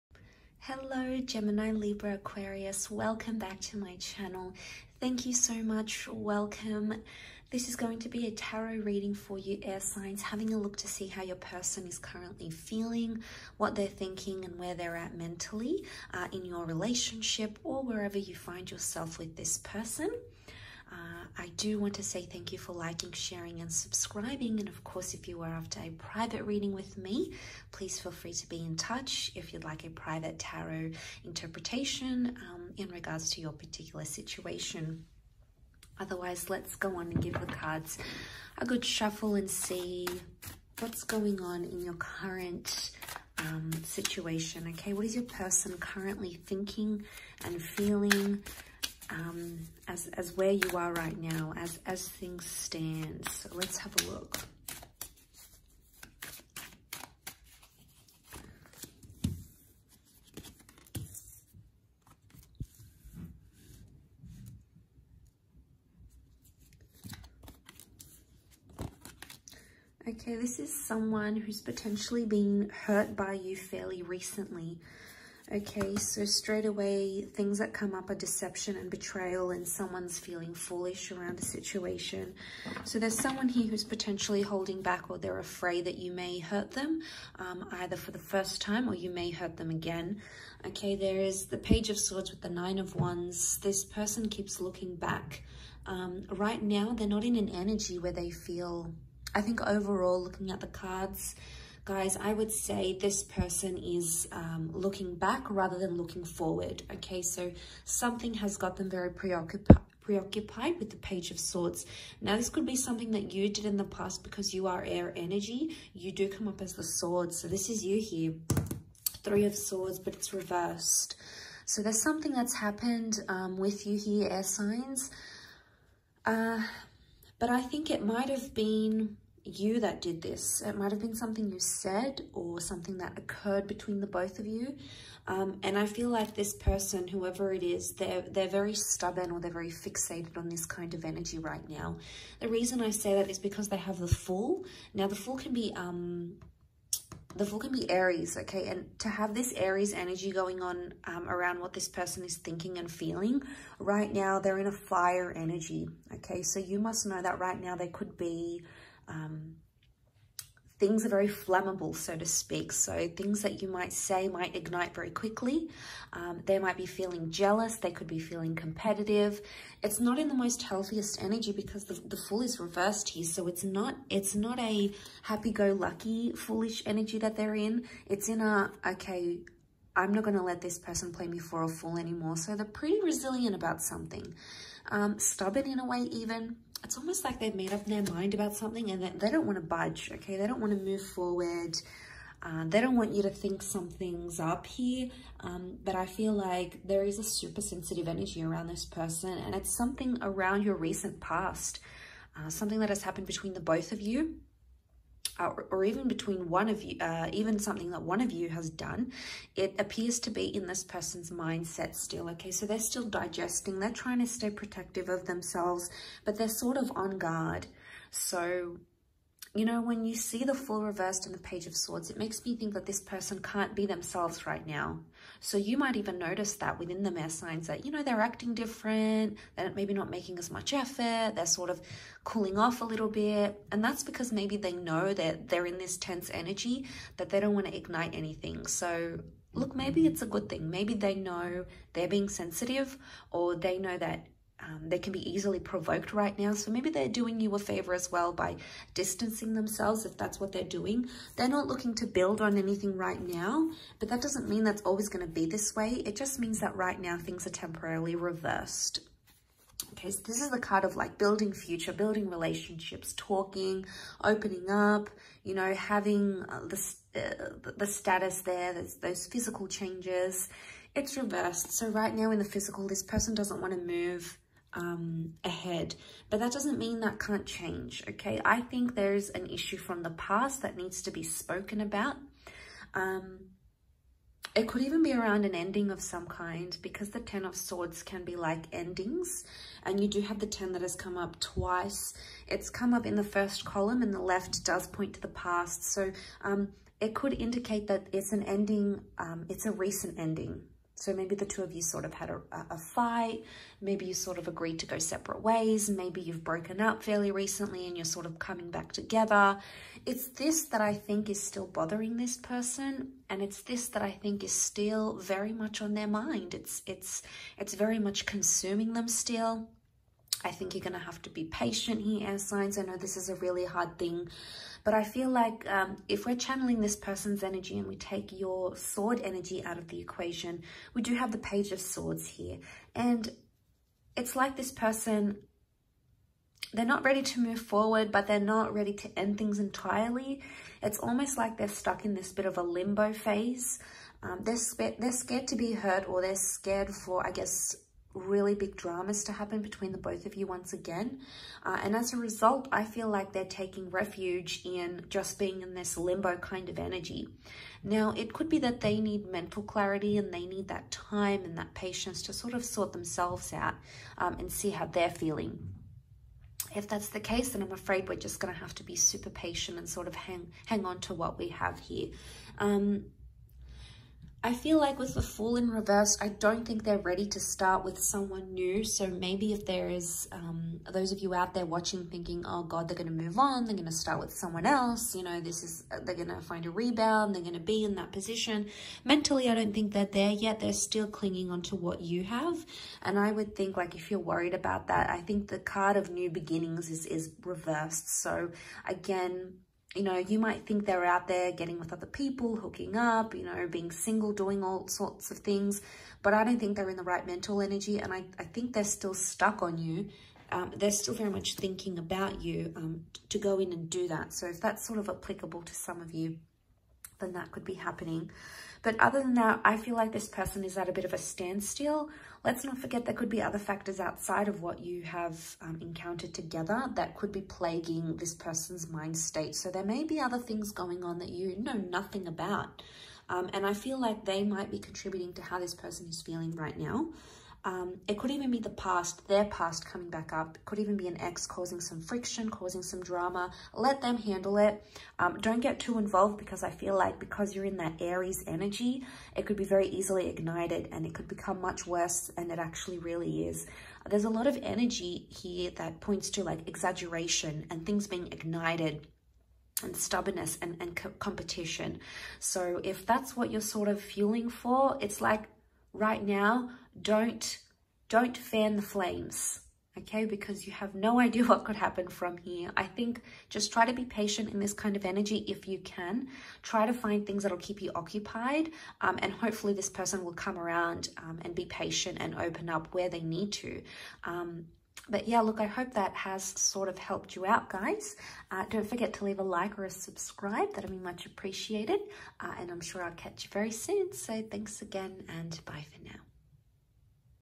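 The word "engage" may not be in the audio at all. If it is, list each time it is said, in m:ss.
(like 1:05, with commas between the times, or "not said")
not said.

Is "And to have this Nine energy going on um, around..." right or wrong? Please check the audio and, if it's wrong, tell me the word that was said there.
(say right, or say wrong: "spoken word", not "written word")
wrong: "Aries", not "Nine".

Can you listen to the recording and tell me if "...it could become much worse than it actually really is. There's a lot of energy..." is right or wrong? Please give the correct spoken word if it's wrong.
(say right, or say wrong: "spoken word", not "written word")
right.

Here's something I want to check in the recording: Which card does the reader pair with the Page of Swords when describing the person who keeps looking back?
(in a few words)
Nine of Wands.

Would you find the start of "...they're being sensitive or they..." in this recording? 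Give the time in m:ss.
4:01.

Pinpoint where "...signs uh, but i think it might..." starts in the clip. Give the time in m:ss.
2:04.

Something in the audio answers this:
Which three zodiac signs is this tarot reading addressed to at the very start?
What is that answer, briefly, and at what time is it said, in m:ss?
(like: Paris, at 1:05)
Gemini, Libra, Aquarius, at 0:01.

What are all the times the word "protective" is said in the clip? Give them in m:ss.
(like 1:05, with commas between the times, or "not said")
3:34.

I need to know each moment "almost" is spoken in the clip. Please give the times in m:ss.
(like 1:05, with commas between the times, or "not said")
3:06, 5:40.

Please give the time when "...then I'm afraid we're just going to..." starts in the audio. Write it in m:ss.
6:07.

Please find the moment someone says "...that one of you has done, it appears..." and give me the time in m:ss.
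3:27.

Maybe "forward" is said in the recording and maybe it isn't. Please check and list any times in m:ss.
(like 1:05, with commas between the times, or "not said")
1:46, 3:11, 5:37.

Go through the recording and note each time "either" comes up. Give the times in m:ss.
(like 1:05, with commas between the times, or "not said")
1:27.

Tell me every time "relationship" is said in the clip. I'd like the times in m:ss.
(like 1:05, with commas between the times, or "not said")
0:16, 4:22.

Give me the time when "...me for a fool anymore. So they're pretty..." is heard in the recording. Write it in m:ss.
3:01.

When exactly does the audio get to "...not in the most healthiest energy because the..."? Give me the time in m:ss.
2:49.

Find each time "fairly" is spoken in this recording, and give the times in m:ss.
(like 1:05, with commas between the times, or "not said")
1:13, 5:07.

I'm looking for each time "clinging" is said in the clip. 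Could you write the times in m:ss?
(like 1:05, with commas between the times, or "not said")
6:31.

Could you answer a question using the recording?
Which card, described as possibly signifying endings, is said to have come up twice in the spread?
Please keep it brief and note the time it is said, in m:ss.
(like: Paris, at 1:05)
Ten of Swords, at 4:47.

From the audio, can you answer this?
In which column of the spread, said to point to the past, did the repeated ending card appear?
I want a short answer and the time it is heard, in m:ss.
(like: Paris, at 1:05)
first column, at 4:53.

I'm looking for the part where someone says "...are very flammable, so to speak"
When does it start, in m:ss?
2:41.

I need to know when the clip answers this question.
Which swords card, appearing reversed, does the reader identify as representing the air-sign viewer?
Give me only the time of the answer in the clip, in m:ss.
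1:59.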